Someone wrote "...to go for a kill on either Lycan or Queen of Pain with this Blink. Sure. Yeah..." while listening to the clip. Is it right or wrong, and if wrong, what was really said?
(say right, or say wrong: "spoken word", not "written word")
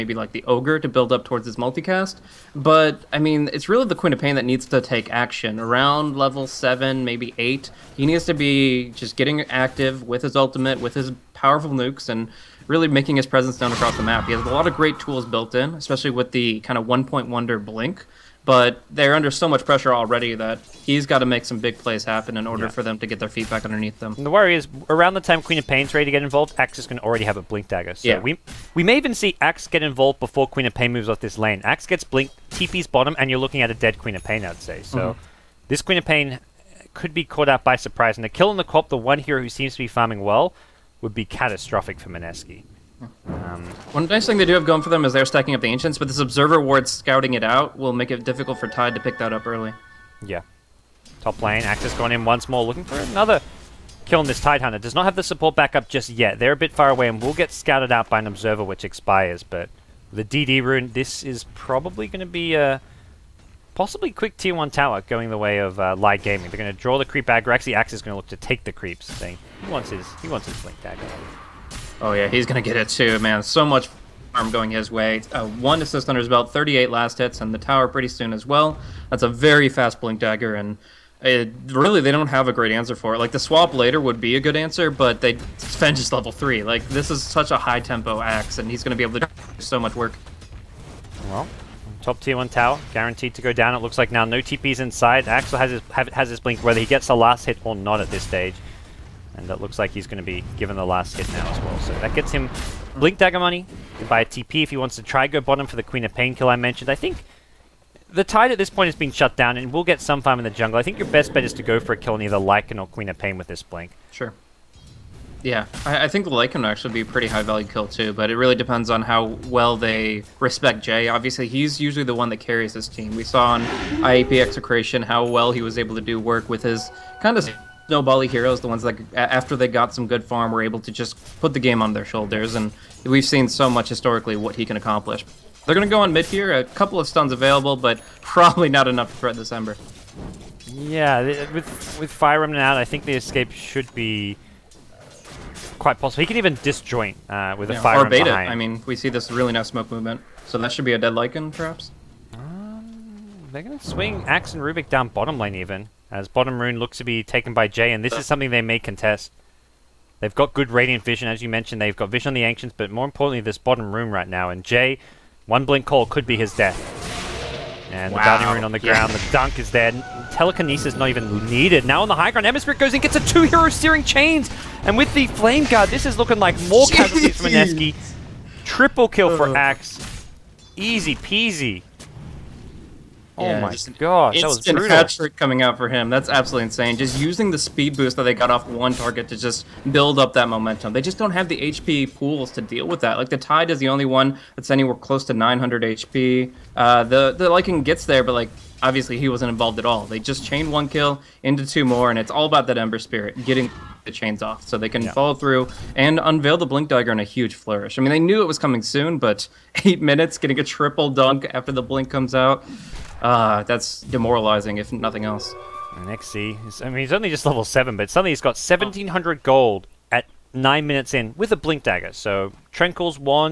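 right.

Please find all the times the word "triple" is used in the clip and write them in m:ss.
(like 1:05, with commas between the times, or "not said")
2:58, 3:30.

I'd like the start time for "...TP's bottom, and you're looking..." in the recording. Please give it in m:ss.
0:32.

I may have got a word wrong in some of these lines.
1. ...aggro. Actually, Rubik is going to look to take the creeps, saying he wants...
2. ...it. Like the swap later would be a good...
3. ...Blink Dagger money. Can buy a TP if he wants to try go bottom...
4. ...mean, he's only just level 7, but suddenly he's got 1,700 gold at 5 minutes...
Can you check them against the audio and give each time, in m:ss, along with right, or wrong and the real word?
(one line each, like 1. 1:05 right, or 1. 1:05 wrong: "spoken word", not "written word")
1. 1:07 wrong: "Axe", not "Rubik"
2. 1:23 right
3. 1:42 right
4. 3:36 wrong: "9", not "5".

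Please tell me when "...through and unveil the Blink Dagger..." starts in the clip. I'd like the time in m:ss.
3:25.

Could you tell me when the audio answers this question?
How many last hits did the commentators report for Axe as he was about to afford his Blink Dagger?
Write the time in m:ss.
1:16.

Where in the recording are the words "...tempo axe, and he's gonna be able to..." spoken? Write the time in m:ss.
1:27.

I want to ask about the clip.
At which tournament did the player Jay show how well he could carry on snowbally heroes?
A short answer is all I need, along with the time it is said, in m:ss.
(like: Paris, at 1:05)
IAP Execration, at 2:03.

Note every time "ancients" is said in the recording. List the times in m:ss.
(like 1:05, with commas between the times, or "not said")
0:45, 2:42.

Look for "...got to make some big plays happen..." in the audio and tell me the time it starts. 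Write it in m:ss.
0:21.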